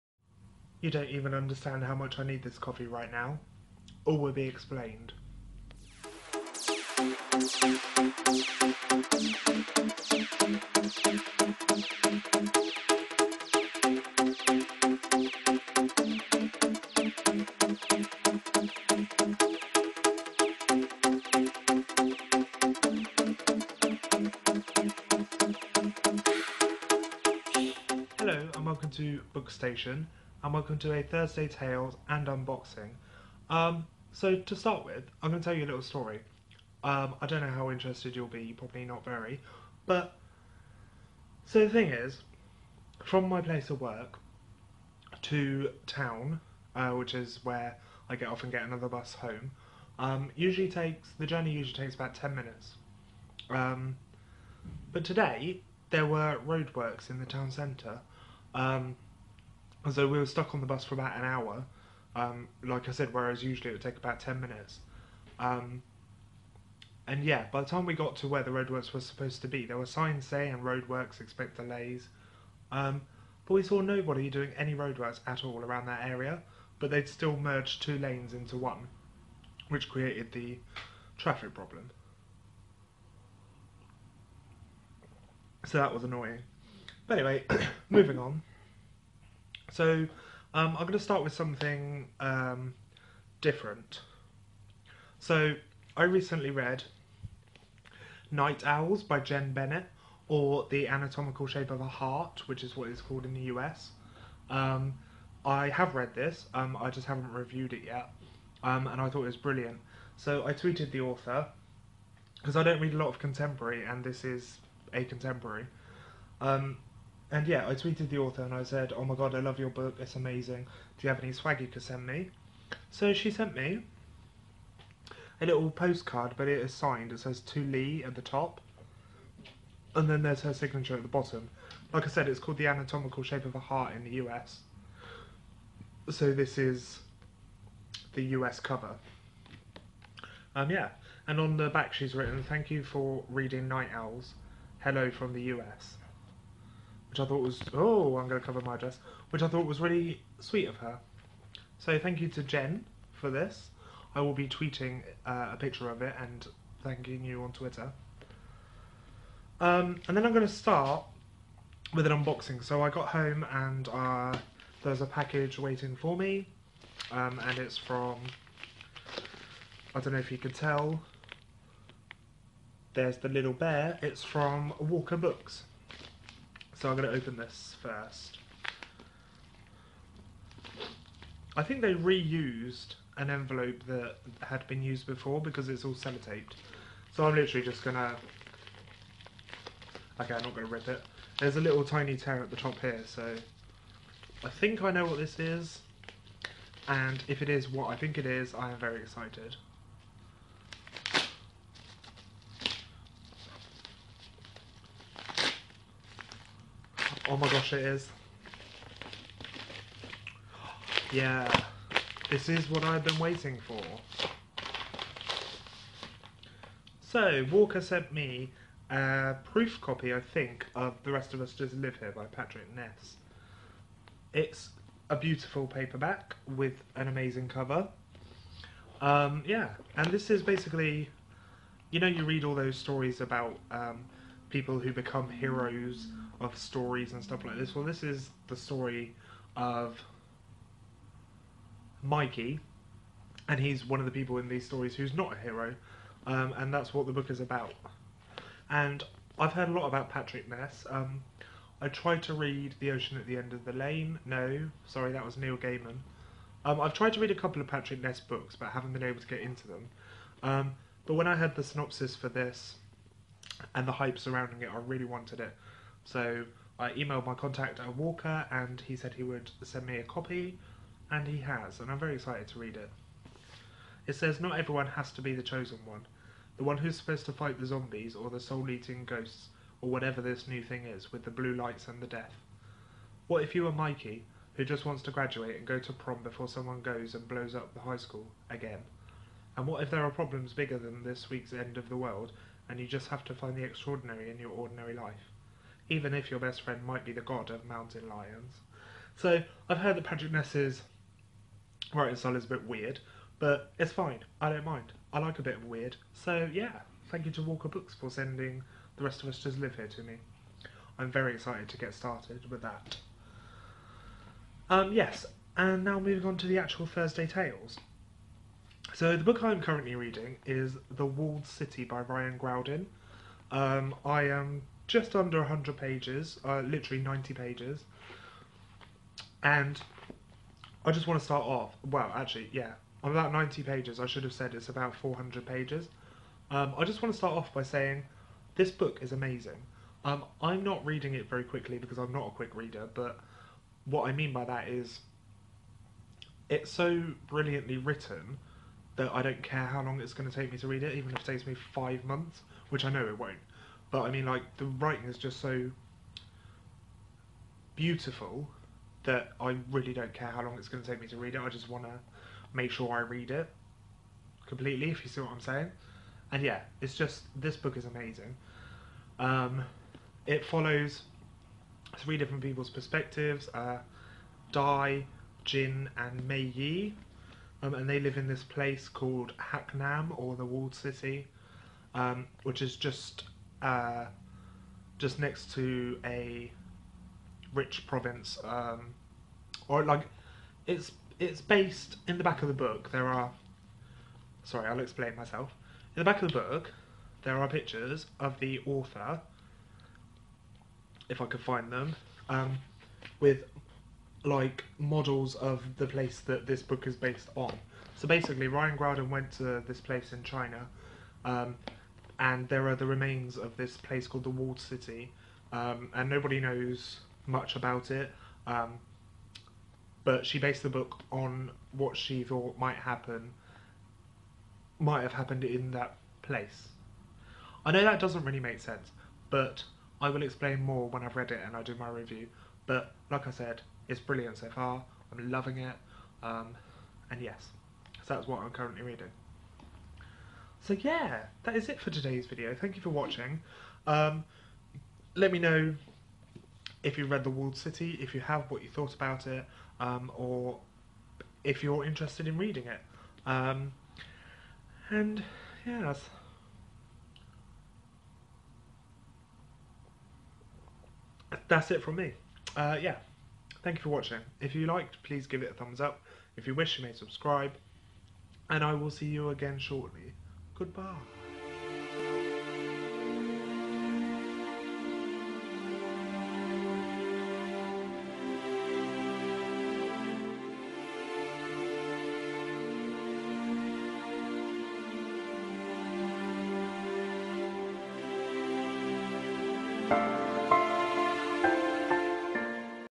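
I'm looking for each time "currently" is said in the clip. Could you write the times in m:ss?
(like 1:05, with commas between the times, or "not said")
5:19, 7:18.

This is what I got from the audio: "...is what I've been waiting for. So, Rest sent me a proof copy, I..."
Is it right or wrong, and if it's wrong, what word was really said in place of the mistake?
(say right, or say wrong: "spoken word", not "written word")
wrong: "Walker", not "Rest".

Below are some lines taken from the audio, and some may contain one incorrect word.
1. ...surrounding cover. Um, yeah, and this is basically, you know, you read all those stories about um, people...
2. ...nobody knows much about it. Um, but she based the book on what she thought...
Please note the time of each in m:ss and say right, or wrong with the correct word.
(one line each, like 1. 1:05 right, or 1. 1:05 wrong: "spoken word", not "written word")
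1. 3:47 wrong: "amazing", not "surrounding"
2. 6:56 right.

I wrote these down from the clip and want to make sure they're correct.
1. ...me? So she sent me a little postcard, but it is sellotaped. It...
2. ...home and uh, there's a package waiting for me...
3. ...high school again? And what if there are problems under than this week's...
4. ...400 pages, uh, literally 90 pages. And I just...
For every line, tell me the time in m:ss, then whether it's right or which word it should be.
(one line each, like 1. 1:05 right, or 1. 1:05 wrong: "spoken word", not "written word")
1. 2:02 wrong: "signed", not "sellotaped"
2. 2:43 right
3. 4:47 wrong: "bigger", not "under"
4. 5:25 wrong: "100", not "400".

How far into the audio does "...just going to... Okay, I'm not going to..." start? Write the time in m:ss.
3:07.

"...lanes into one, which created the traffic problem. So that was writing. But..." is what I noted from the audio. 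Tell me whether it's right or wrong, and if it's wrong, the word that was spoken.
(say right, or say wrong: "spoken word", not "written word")
wrong: "annoying", not "writing".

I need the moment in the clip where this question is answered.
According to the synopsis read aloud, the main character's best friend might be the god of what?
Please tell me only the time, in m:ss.
4:57.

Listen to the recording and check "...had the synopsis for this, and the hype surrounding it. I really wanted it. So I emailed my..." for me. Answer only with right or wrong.
right.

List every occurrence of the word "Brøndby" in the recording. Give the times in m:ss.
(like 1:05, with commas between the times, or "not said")
not said.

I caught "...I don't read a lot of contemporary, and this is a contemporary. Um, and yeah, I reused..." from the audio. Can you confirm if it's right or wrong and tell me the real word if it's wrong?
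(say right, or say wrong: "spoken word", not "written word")
wrong: "tweeted", not "reused".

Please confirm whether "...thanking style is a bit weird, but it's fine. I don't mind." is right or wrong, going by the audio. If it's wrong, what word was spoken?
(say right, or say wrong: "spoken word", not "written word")
wrong: "writing", not "thanking".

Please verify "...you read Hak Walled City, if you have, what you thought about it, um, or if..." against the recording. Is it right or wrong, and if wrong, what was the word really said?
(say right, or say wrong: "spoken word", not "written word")
wrong: "The", not "Hak".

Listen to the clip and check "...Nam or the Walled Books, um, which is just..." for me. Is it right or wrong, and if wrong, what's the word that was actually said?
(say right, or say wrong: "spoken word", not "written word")
wrong: "City", not "Books".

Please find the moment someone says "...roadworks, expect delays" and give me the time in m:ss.
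1:10.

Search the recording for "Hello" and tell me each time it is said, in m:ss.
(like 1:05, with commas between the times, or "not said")
0:28, 2:24.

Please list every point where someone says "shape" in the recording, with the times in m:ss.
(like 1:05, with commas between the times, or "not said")
1:41, 2:13.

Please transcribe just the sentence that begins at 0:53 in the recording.
Um, but today there were roadworks in the town centre.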